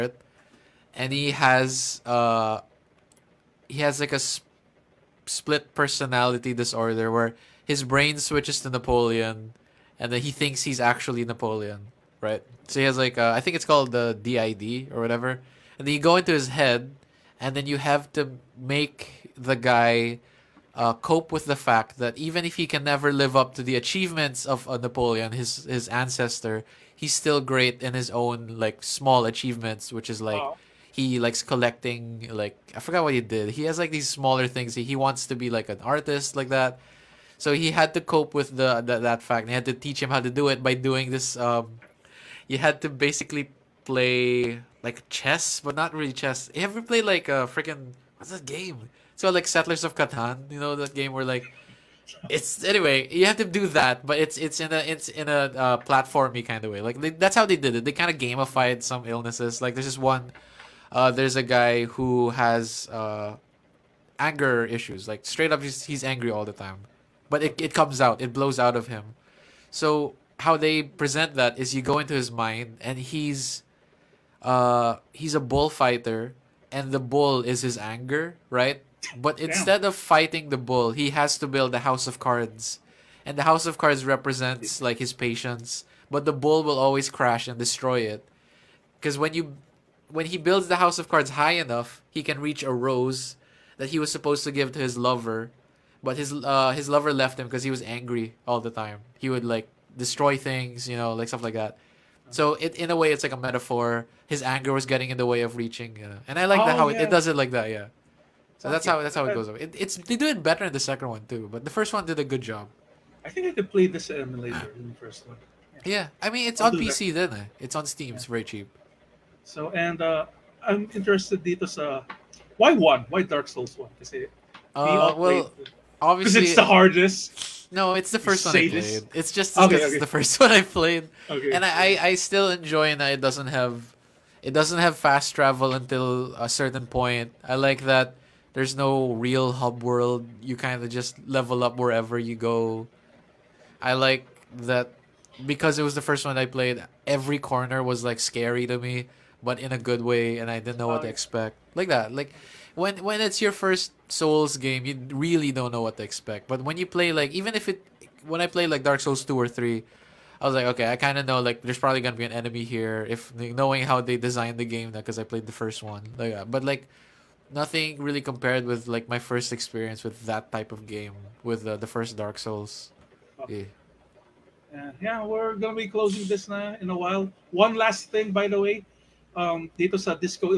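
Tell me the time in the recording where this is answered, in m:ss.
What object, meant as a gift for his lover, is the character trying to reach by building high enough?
1:32.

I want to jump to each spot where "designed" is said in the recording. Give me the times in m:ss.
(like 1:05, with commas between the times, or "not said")
2:44.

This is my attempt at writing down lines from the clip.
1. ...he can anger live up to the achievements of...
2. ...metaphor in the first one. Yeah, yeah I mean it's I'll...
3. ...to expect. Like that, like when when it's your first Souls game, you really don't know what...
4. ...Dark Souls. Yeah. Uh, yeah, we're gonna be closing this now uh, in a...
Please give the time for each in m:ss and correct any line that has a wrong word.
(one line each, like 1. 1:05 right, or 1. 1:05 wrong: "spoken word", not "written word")
1. 0:22 wrong: "never", not "anger"
2. 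1:54 wrong: "emulator", not "metaphor"
3. 2:31 right
4. 2:52 right.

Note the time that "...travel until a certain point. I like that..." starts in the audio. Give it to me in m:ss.
2:15.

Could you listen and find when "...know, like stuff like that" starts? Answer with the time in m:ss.
1:40.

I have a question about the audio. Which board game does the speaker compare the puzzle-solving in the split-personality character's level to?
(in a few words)
Settlers of Catan.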